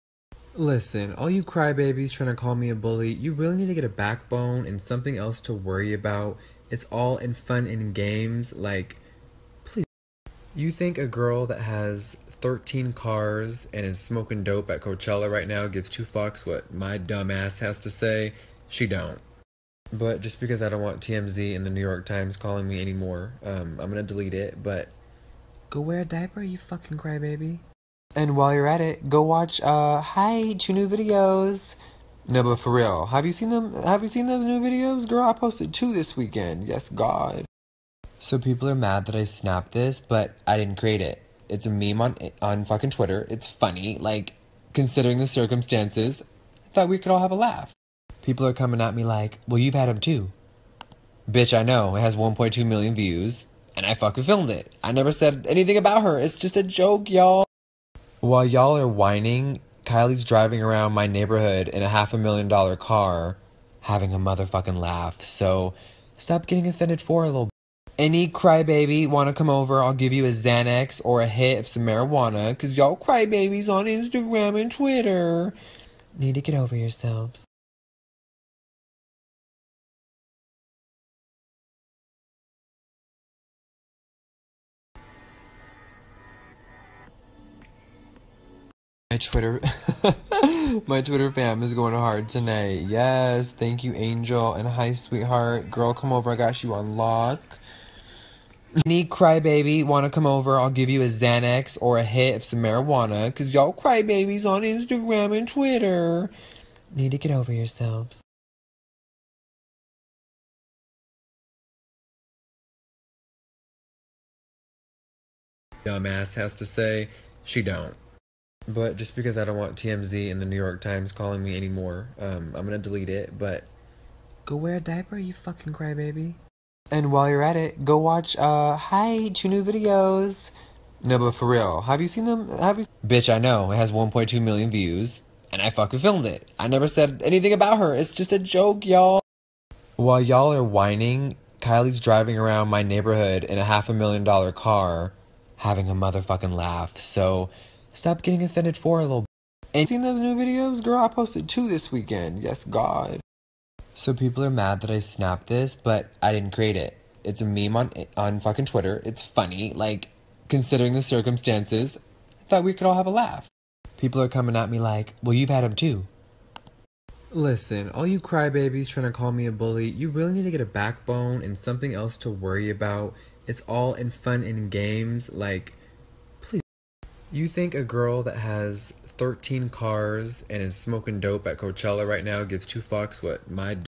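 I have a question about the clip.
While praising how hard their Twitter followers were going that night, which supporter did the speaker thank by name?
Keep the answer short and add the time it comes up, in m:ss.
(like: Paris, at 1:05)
Angel, at 1:33.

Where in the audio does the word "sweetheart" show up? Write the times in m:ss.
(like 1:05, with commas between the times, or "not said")
1:34.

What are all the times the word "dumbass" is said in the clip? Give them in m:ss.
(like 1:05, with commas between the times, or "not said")
0:16, 1:55.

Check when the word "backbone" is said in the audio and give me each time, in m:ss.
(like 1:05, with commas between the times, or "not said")
0:03, 2:50.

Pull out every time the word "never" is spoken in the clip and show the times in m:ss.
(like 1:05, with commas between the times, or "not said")
0:54, 2:16.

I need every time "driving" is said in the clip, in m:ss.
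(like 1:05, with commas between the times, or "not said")
1:00, 2:21.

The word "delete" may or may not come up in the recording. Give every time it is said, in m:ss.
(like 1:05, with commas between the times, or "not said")
0:24, 2:02.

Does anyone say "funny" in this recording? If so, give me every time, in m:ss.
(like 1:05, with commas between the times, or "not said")
0:43, 2:39.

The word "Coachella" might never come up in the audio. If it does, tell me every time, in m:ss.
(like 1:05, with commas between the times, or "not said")
0:14, 3:01.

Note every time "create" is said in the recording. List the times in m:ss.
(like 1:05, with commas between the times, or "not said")
0:40, 2:36.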